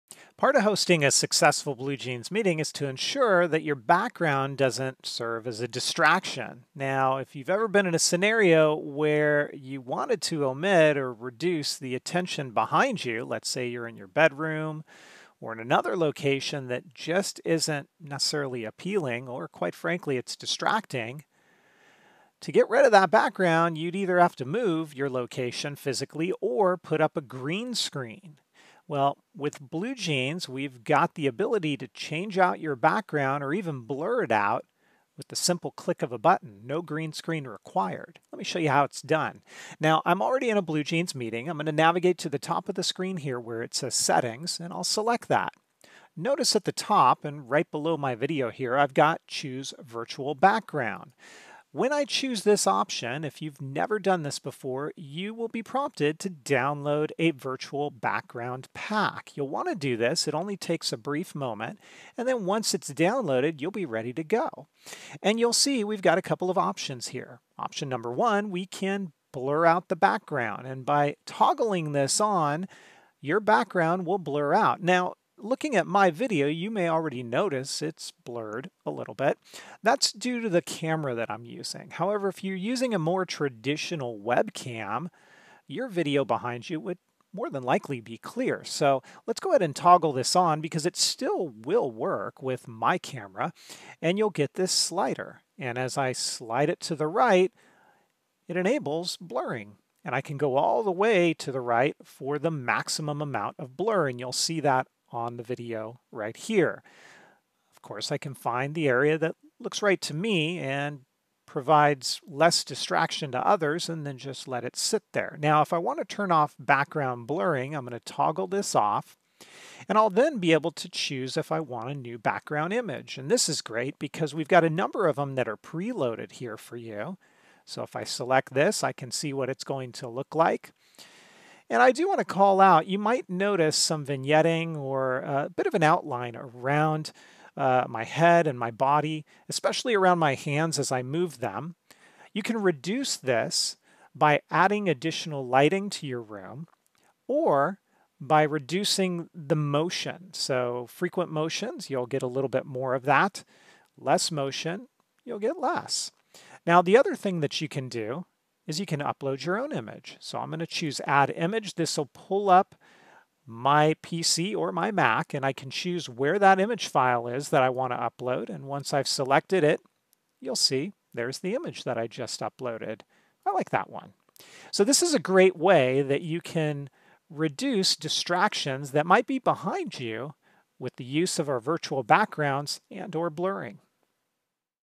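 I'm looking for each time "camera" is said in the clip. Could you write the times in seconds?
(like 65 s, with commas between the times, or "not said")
80 s, 92 s.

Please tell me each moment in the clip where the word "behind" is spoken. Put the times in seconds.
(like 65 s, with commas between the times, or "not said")
12 s, 86 s, 179 s.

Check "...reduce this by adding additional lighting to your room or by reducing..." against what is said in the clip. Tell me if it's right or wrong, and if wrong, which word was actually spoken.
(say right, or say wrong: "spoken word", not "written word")
right.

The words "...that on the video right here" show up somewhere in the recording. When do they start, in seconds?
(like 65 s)
104 s.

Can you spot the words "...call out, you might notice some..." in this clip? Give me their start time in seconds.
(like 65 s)
132 s.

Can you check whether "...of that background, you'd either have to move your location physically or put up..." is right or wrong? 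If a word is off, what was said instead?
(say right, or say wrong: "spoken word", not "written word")
right.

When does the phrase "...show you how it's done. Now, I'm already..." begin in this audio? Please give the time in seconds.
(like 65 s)
38 s.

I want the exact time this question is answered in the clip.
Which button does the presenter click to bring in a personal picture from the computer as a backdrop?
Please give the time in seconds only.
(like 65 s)
161 s.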